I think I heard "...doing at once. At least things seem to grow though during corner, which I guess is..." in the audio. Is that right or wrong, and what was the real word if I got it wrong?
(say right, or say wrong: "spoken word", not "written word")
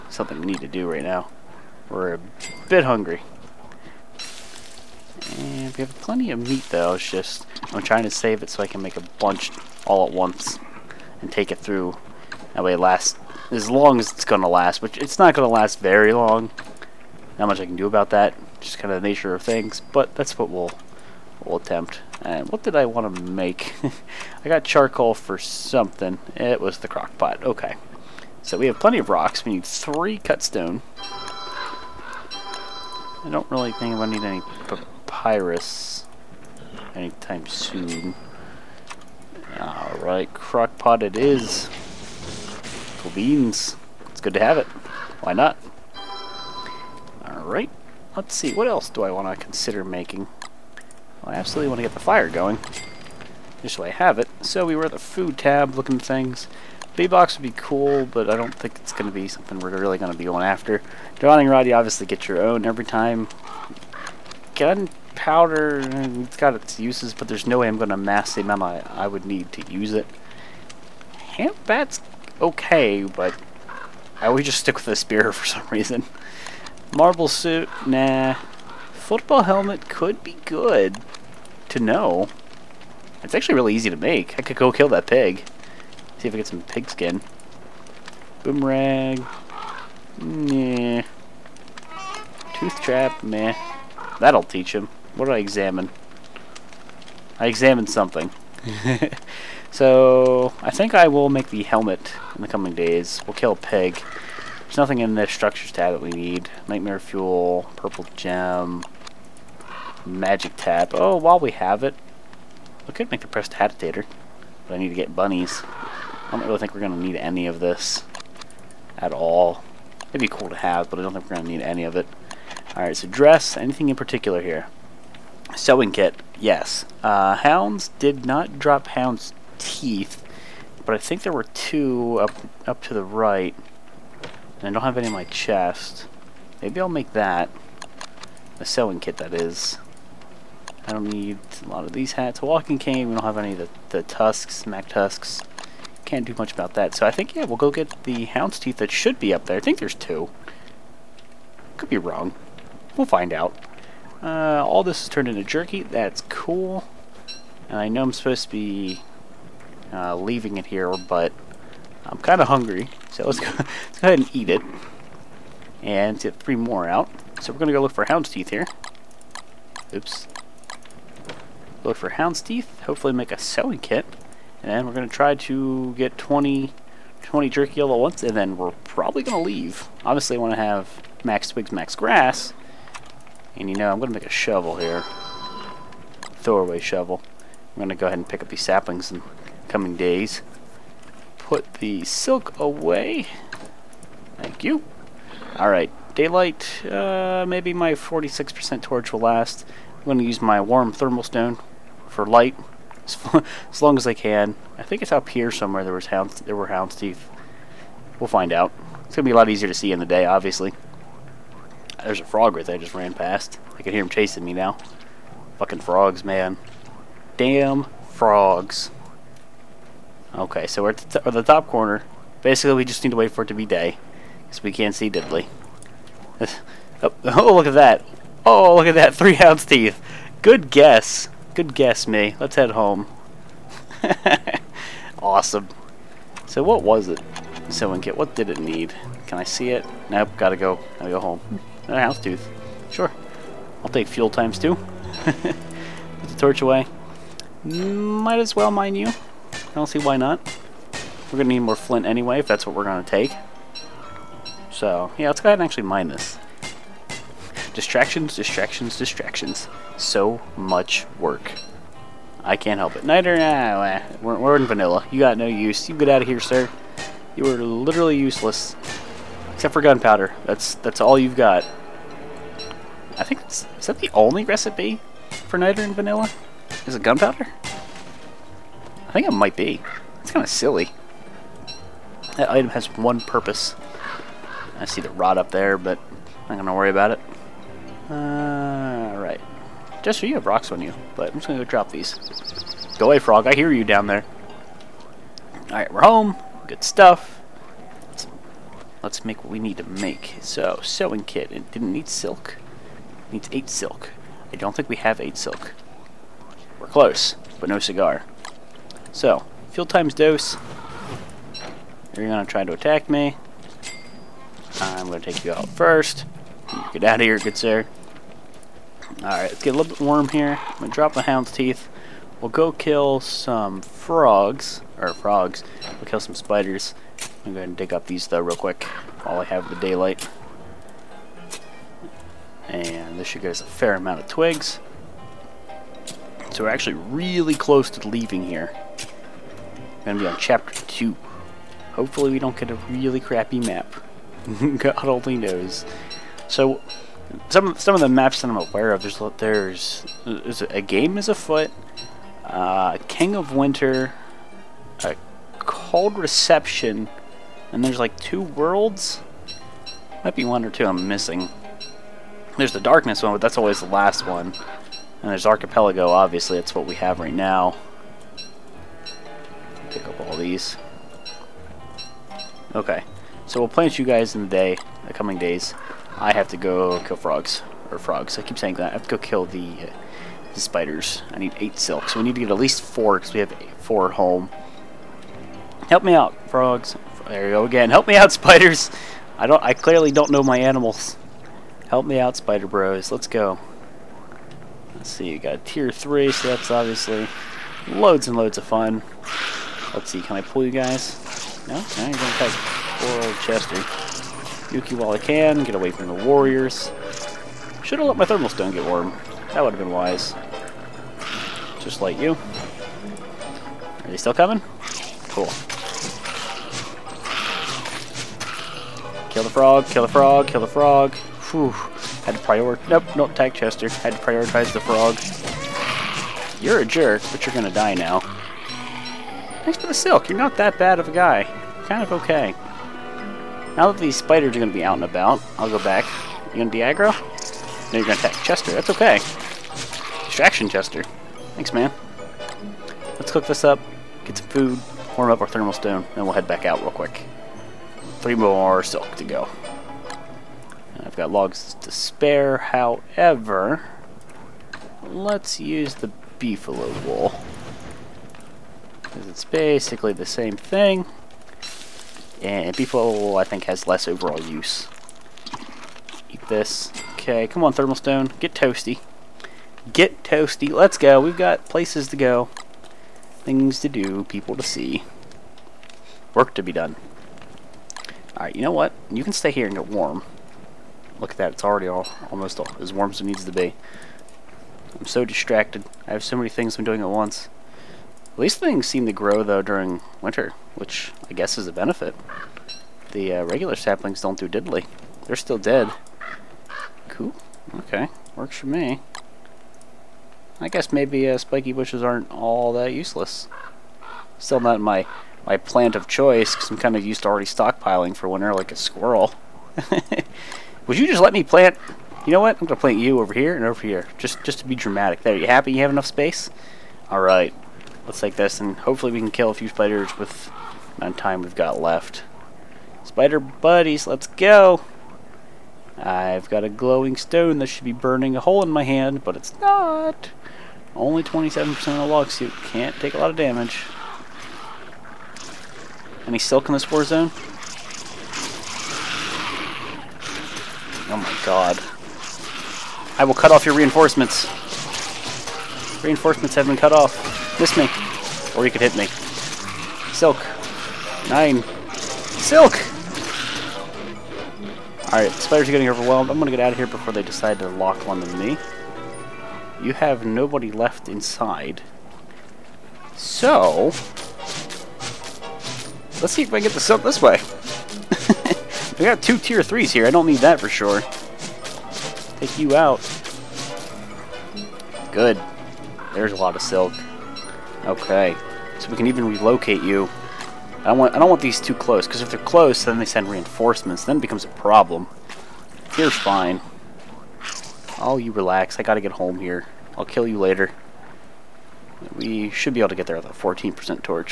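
wrong: "winter", not "corner".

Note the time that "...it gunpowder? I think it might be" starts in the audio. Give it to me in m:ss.
4:36.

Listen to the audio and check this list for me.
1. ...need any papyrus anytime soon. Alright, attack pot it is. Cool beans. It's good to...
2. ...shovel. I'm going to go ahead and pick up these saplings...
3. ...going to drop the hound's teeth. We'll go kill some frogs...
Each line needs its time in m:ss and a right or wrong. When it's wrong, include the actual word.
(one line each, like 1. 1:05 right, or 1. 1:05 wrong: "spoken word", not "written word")
1. 0:34 wrong: "crock", not "attack"
2. 3:06 right
3. 5:20 right.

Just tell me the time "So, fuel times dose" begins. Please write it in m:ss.
5:09.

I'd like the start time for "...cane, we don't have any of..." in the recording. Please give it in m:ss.
2:22.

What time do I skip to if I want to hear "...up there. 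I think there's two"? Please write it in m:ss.
2:29.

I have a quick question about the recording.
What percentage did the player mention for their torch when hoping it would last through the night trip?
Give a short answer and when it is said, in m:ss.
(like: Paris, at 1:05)
46%, at 3:17.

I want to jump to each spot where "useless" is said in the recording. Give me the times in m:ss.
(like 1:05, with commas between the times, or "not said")
4:28, 8:22.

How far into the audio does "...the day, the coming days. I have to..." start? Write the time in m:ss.
6:14.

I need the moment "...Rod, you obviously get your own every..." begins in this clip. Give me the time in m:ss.
1:01.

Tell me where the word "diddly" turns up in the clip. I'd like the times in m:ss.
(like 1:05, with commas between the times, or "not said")
3:45, 8:14.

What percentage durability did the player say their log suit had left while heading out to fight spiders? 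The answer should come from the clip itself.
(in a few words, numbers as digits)
27%.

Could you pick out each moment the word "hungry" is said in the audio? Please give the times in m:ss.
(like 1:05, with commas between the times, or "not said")
0:02, 2:42.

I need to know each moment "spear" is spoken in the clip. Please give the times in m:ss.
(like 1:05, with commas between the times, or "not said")
1:14.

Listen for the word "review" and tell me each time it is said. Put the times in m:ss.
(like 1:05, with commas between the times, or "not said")
not said.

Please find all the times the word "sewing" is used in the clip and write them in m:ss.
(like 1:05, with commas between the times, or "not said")
2:05, 2:18, 2:53, 5:00.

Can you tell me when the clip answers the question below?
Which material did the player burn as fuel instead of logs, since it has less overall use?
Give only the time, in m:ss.
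7:36.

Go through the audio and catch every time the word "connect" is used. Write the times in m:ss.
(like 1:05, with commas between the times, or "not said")
not said.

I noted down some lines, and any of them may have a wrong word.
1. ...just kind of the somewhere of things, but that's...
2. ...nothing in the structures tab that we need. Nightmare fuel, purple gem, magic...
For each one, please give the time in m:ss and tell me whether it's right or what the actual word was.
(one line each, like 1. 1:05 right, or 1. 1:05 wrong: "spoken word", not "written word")
1. 0:18 wrong: "nature", not "somewhere"
2. 1:44 right.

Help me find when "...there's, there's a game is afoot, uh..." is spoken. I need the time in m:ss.
5:49.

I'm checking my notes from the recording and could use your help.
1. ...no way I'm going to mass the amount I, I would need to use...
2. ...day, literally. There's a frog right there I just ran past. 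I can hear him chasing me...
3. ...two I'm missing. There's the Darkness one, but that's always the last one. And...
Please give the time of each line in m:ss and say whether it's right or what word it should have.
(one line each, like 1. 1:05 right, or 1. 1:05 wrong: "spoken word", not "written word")
1. 1:07 right
2. 3:30 wrong: "obviously", not "literally"
3. 6:00 right.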